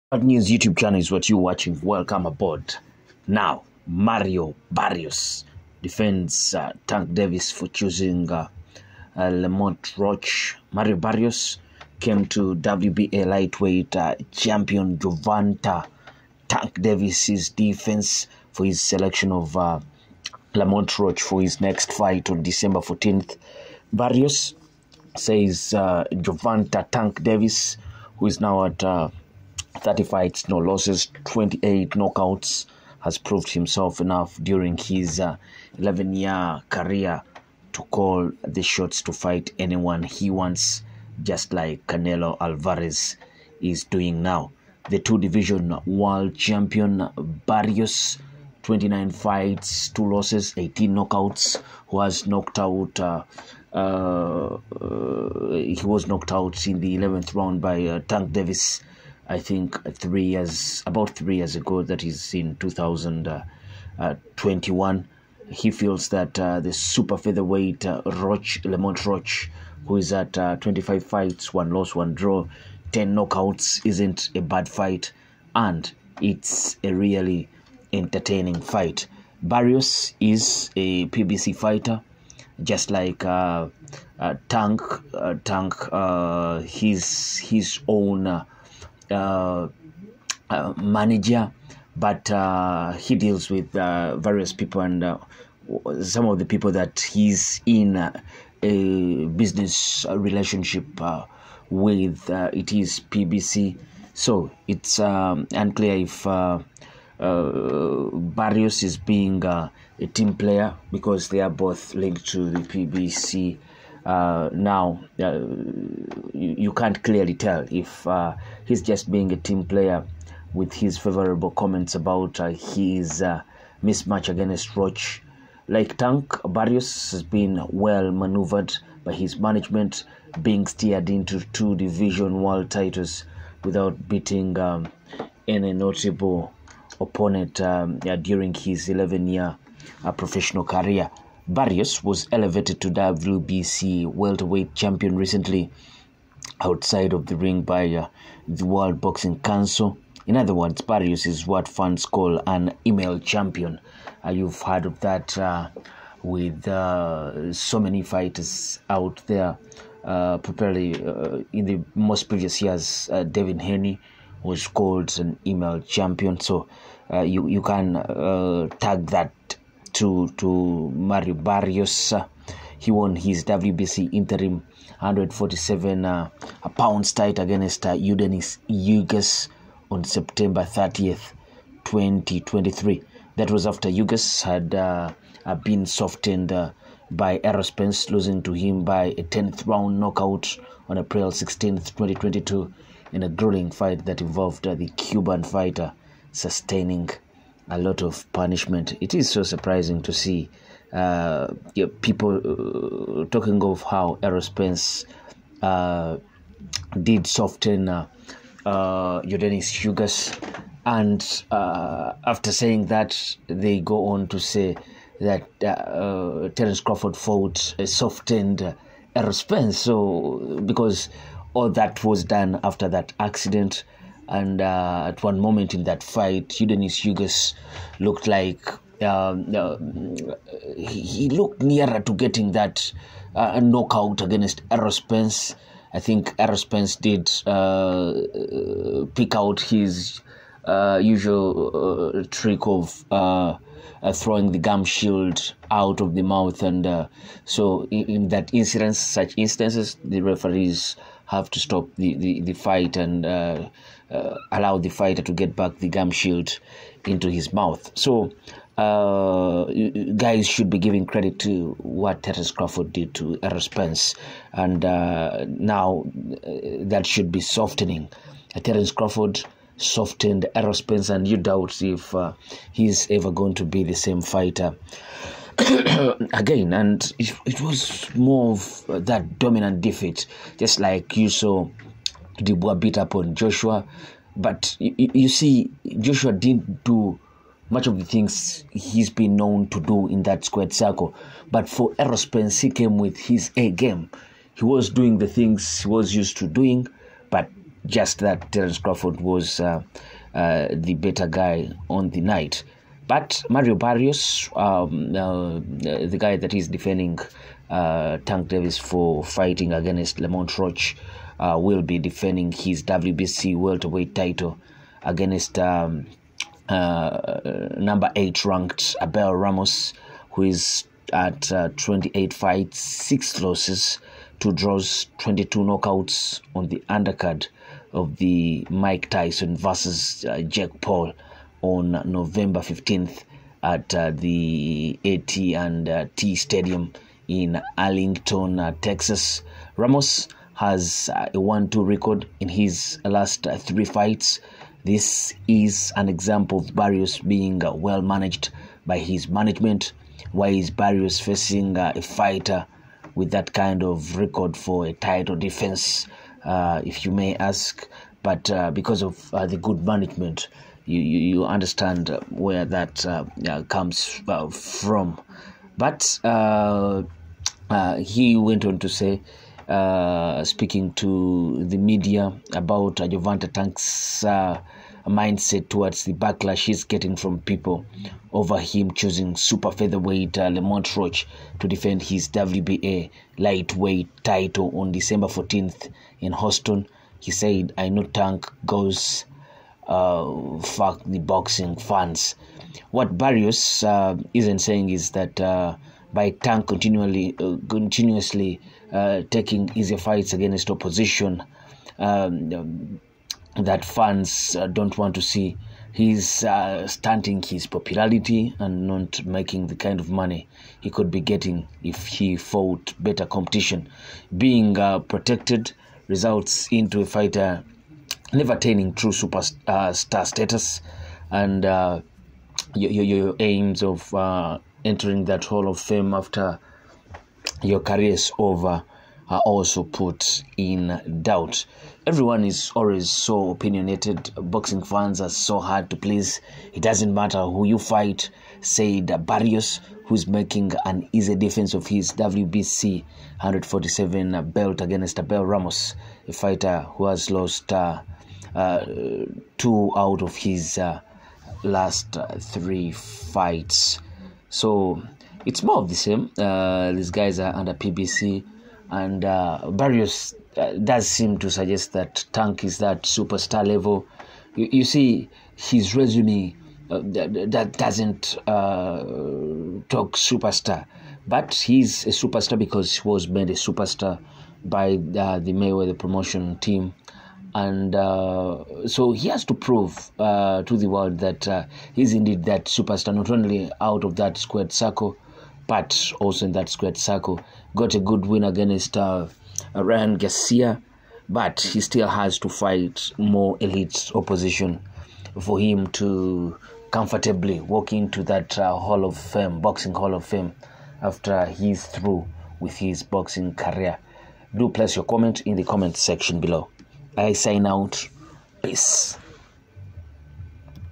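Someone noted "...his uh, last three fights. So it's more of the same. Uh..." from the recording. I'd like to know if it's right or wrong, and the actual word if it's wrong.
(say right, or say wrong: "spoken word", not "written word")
right.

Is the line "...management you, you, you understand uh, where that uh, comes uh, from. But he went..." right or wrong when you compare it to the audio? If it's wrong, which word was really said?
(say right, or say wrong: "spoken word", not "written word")
right.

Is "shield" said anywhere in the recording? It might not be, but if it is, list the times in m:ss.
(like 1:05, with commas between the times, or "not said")
4:04, 4:16.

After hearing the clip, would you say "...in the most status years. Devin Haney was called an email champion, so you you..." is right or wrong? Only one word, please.
wrong.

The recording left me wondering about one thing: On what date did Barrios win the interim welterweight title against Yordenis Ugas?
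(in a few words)
September 30th, 2023.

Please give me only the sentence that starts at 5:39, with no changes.
Ramos has uh, a 1 2 record in his last three fights.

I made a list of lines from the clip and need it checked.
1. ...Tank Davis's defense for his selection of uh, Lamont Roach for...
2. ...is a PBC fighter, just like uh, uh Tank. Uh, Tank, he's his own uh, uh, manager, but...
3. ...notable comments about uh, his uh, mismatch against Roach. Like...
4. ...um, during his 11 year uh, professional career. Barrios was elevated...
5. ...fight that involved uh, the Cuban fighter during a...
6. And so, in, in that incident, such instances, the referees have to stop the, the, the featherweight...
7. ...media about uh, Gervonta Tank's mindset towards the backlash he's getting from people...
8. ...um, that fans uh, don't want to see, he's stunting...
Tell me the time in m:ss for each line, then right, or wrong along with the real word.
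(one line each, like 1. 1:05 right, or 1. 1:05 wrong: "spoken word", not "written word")
1. 0:16 right
2. 1:20 right
3. 2:00 wrong: "favorable", not "notable"
4. 2:17 right
5. 3:13 wrong: "sustaining", not "during"
6. 4:06 wrong: "fight", not "featherweight"
7. 6:11 right
8. 6:41 right.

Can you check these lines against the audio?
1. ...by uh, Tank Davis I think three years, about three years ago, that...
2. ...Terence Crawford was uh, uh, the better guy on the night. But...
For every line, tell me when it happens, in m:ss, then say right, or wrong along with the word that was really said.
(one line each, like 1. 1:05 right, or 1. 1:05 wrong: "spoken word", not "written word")
1. 0:57 right
2. 4:58 right.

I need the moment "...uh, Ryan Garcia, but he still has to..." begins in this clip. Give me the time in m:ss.
8:08.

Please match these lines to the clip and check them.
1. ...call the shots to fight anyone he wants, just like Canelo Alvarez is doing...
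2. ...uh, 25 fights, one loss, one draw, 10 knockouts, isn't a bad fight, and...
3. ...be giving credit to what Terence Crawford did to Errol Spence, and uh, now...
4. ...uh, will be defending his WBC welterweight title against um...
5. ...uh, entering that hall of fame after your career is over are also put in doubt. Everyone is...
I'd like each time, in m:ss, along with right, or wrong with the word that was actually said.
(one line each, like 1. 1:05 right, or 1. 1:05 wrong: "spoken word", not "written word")
1. 0:37 right
2. 1:10 right
3. 4:20 right
4. 5:11 right
5. 7:04 right.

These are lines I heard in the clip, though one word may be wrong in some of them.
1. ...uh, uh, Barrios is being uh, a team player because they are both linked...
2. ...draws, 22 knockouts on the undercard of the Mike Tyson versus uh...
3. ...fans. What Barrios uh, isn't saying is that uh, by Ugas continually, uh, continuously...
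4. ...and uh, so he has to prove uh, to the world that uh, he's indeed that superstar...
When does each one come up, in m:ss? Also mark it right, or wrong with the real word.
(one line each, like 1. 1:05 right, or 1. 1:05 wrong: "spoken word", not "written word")
1. 1:46 right
2. 5:24 right
3. 6:31 wrong: "Tank", not "Ugas"
4. 7:57 right.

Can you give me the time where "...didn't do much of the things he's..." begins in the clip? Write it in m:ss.
4:46.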